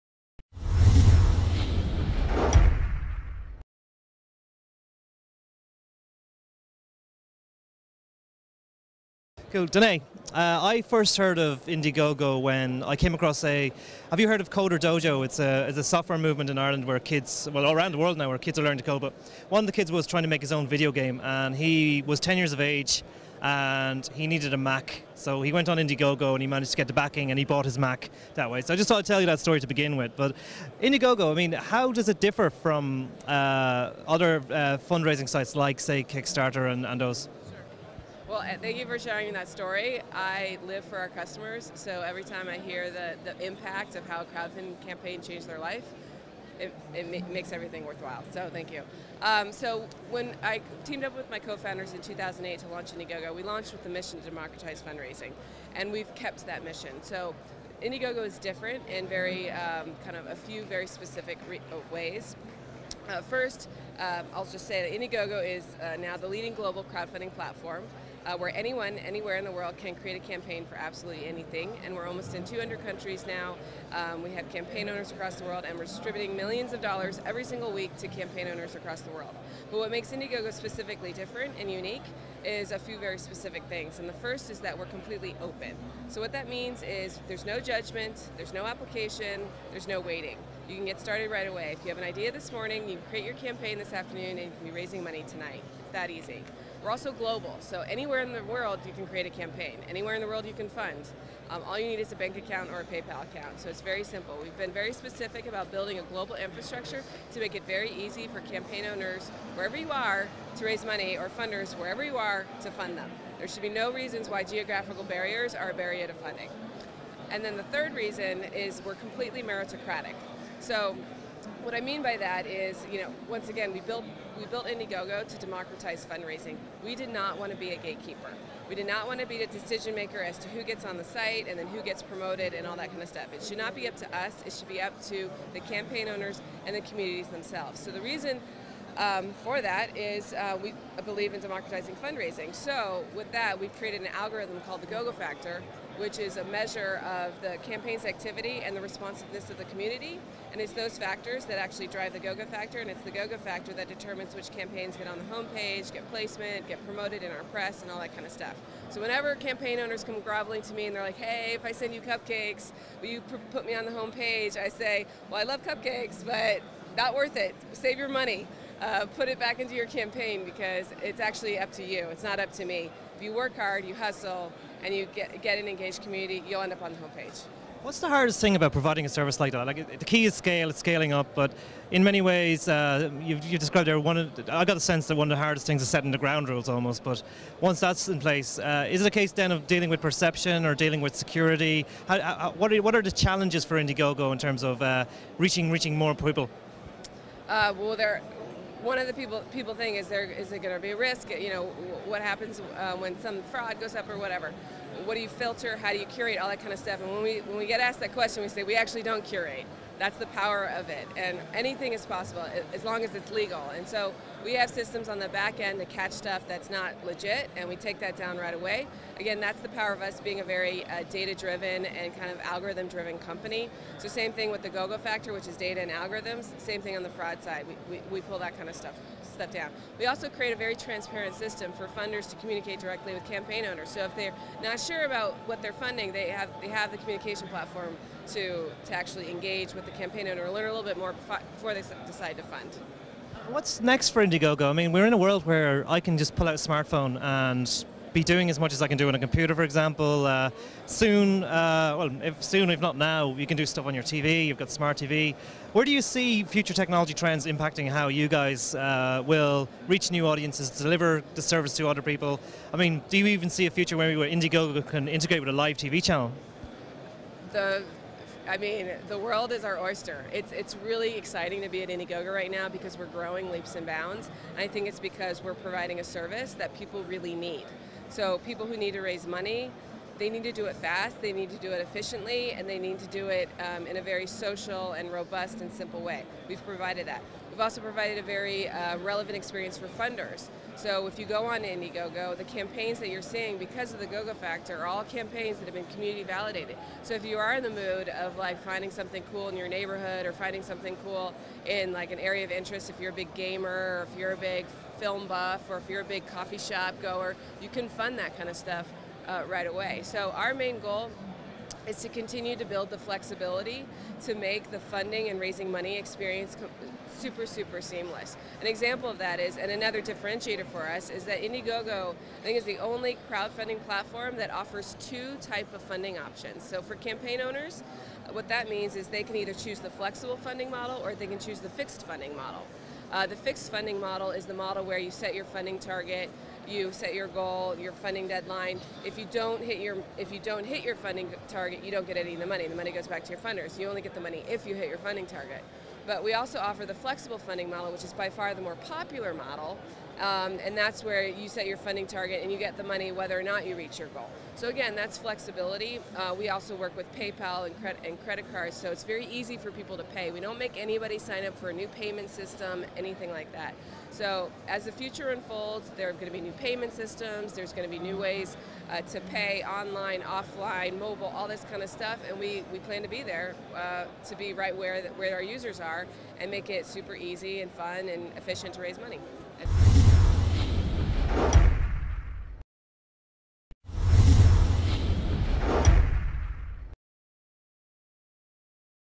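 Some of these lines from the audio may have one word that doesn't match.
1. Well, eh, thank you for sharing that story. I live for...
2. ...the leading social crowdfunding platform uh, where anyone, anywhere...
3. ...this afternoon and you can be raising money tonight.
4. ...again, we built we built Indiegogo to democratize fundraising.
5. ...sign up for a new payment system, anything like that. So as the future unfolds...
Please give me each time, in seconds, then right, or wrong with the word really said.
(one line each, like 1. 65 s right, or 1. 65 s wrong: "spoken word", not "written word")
1. 38 s right
2. 66 s wrong: "global", not "social"
3. 93 s right
4. 123 s right
5. 361 s right.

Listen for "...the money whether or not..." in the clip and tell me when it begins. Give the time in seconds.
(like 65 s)
352 s.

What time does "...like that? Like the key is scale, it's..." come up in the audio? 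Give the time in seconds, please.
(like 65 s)
179 s.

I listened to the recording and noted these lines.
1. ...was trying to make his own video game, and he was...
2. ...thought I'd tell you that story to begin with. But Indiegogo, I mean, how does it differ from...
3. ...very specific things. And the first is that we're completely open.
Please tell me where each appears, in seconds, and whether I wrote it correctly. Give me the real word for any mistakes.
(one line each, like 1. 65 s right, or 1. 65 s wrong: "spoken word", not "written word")
1. 19 s right
2. 28 s right
3. 82 s right.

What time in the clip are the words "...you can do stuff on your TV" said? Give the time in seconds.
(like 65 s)
253 s.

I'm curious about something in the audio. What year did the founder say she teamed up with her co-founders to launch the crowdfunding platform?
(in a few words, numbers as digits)
2008.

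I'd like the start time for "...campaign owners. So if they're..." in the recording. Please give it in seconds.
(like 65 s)
233 s.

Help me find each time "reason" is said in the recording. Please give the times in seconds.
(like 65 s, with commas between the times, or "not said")
113 s, 117 s, 138 s.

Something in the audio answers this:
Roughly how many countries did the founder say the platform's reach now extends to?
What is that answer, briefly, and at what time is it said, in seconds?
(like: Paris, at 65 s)
200, at 72 s.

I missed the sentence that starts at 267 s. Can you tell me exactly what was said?
The I mean, the world is our oyster.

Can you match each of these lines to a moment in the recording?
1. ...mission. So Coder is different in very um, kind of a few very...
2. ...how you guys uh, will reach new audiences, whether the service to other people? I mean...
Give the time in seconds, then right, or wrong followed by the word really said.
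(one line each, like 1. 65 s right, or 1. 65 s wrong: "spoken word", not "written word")
1. 56 s wrong: "Indiegogo", not "Coder"
2. 257 s wrong: "deliver", not "whether".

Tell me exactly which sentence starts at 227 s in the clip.
We, we, we pull that kind of stuff step down.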